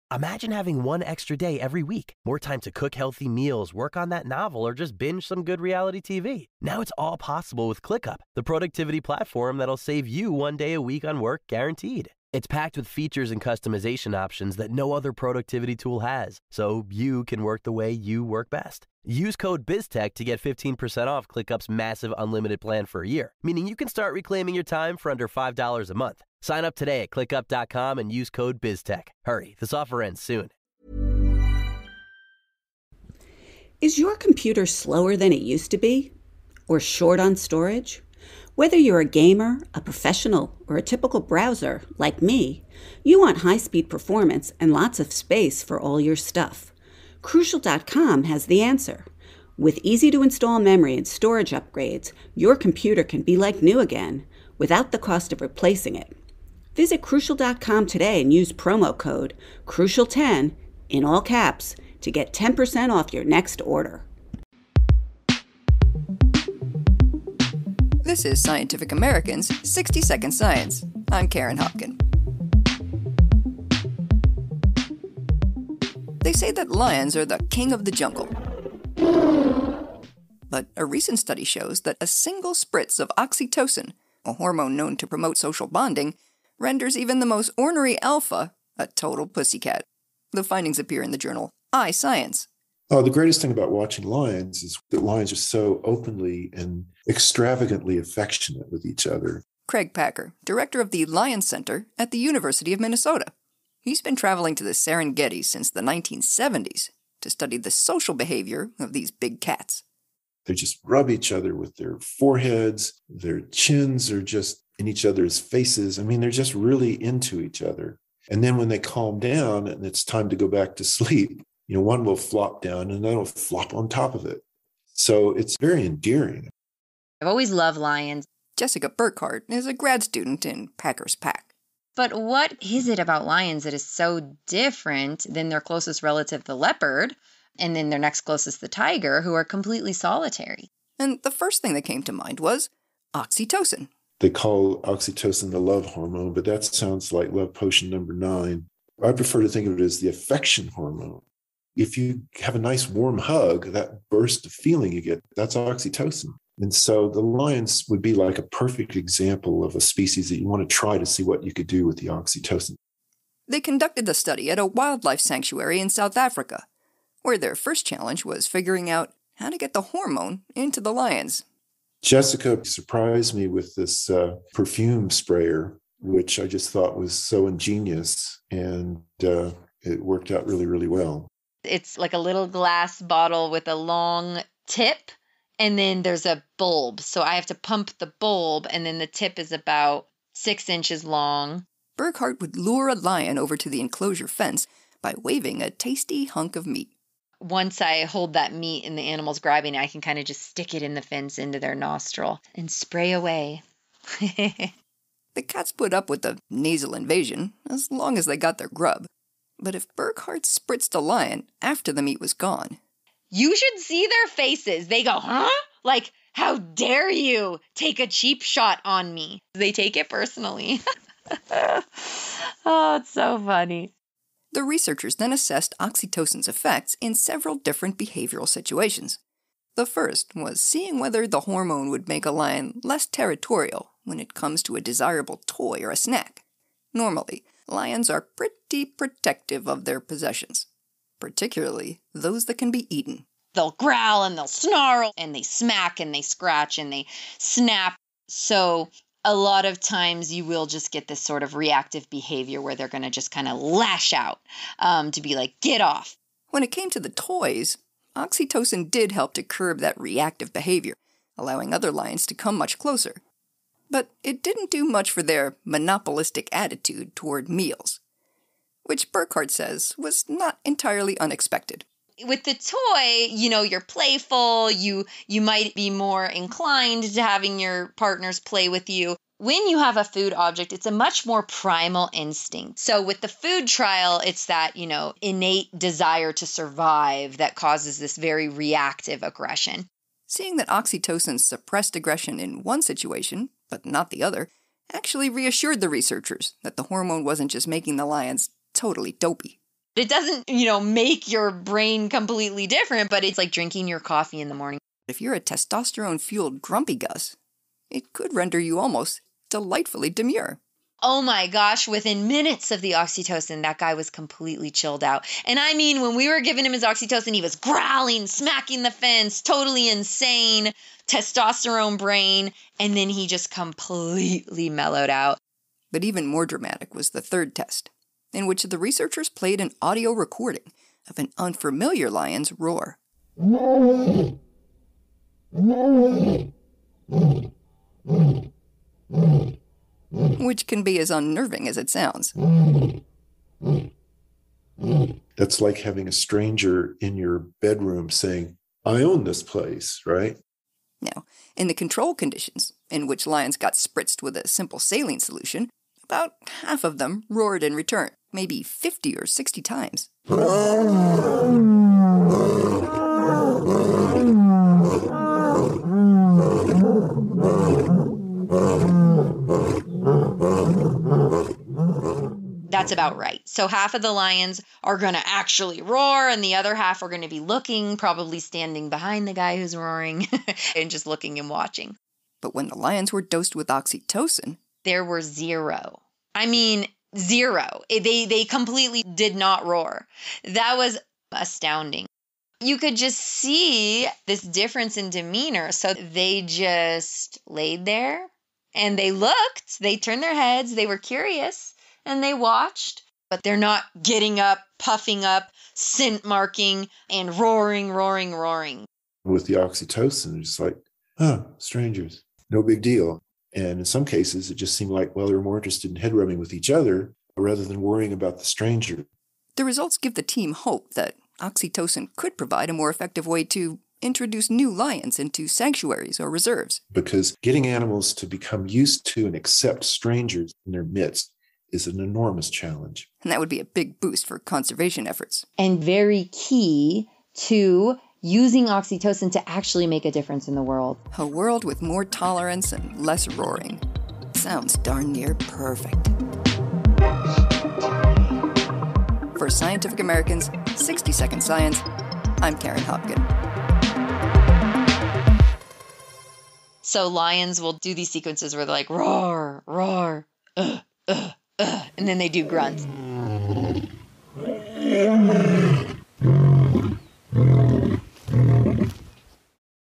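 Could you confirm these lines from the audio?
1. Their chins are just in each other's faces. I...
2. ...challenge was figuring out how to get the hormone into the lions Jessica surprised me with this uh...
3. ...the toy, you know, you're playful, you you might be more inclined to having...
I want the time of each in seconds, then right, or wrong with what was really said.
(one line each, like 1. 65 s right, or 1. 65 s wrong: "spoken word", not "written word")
1. 113 s right
2. 167 s right
3. 272 s right.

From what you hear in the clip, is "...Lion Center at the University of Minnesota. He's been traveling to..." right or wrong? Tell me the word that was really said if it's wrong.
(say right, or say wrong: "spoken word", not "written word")
right.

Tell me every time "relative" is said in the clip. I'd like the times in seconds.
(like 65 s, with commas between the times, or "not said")
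136 s.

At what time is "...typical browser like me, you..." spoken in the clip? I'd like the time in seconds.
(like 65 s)
40 s.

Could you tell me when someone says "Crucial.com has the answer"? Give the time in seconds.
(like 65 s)
47 s.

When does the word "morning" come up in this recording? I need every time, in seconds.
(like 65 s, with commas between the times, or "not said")
304 s.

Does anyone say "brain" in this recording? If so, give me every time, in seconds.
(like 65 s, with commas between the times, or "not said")
301 s, 321 s.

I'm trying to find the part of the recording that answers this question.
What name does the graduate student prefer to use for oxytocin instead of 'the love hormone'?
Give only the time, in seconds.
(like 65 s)
149 s.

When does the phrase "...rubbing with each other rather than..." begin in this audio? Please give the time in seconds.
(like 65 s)
416 s.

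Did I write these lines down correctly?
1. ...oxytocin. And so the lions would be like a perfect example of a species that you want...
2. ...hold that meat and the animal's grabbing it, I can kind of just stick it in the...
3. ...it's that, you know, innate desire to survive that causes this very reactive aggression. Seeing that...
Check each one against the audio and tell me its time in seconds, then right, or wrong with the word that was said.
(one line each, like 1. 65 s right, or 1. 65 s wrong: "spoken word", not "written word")
1. 155 s right
2. 198 s right
3. 284 s right.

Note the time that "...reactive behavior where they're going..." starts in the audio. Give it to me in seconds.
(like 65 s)
251 s.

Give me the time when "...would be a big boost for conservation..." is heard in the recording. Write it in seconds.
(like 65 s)
433 s.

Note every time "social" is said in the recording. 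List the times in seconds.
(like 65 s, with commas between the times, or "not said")
85 s, 107 s.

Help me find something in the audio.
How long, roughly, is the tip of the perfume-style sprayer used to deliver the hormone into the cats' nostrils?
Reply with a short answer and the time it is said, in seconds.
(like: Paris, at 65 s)
6 inches, at 190 s.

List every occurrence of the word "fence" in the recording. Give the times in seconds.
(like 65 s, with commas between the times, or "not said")
194 s, 201 s, 318 s.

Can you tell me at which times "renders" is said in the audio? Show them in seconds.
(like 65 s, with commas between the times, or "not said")
86 s, 308 s.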